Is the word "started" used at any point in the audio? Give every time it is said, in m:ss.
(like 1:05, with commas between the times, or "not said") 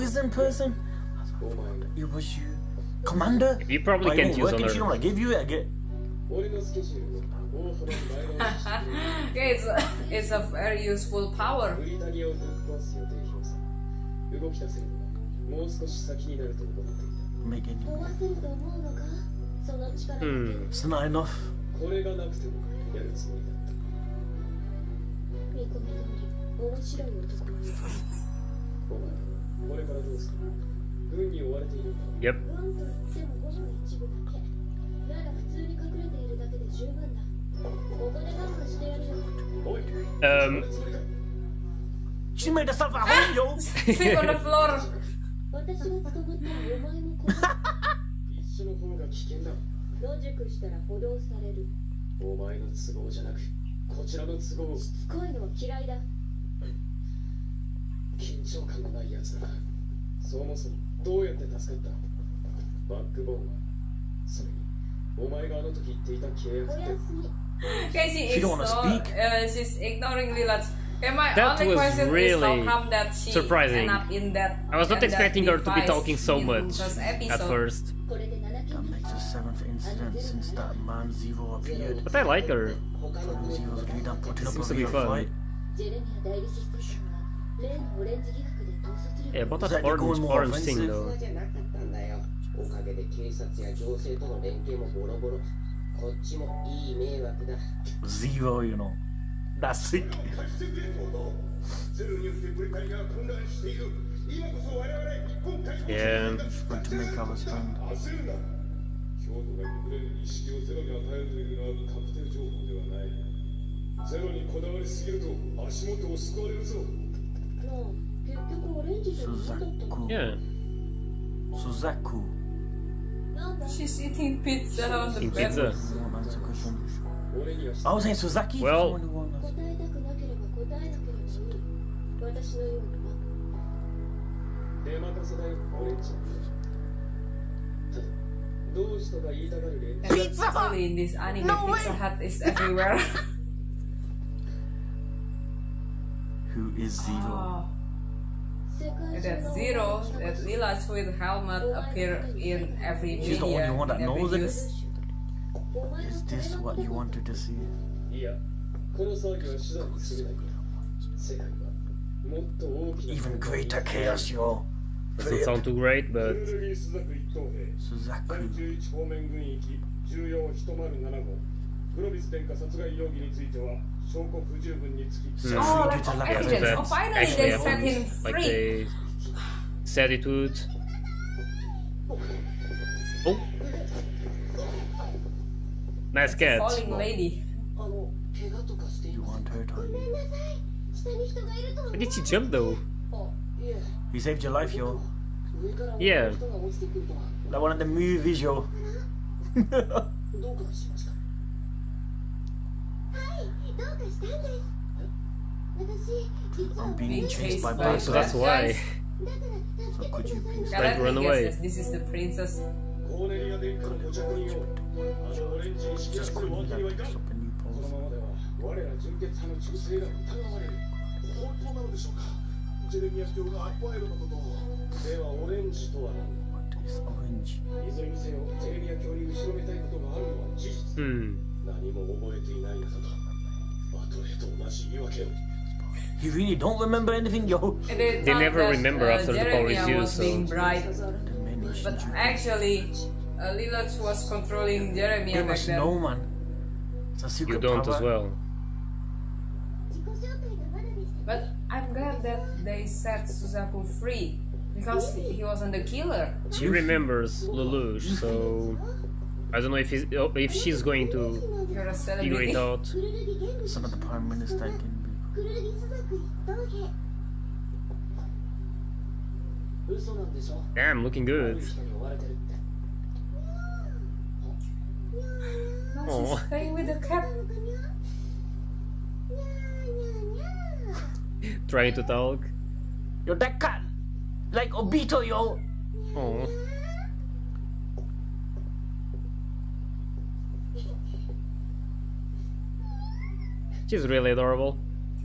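not said.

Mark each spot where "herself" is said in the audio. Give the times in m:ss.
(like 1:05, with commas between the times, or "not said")
0:42.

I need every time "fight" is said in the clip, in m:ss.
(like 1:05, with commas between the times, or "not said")
1:25.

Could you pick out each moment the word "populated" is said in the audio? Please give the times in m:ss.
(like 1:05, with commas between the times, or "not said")
not said.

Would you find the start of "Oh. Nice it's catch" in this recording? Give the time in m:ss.
3:03.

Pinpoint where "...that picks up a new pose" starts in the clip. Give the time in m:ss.
3:36.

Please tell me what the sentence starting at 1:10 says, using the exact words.
Okay, my that only question really is how come that she surprising.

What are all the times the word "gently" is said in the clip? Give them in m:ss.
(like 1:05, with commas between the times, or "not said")
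not said.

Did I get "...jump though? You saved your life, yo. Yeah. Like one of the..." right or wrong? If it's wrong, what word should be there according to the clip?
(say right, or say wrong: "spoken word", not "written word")
right.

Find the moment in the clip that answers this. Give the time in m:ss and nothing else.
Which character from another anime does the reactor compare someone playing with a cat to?
4:44.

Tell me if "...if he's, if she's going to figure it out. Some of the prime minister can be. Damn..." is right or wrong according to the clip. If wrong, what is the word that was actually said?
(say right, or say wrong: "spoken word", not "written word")
right.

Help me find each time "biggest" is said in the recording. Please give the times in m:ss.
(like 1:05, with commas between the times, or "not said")
not said.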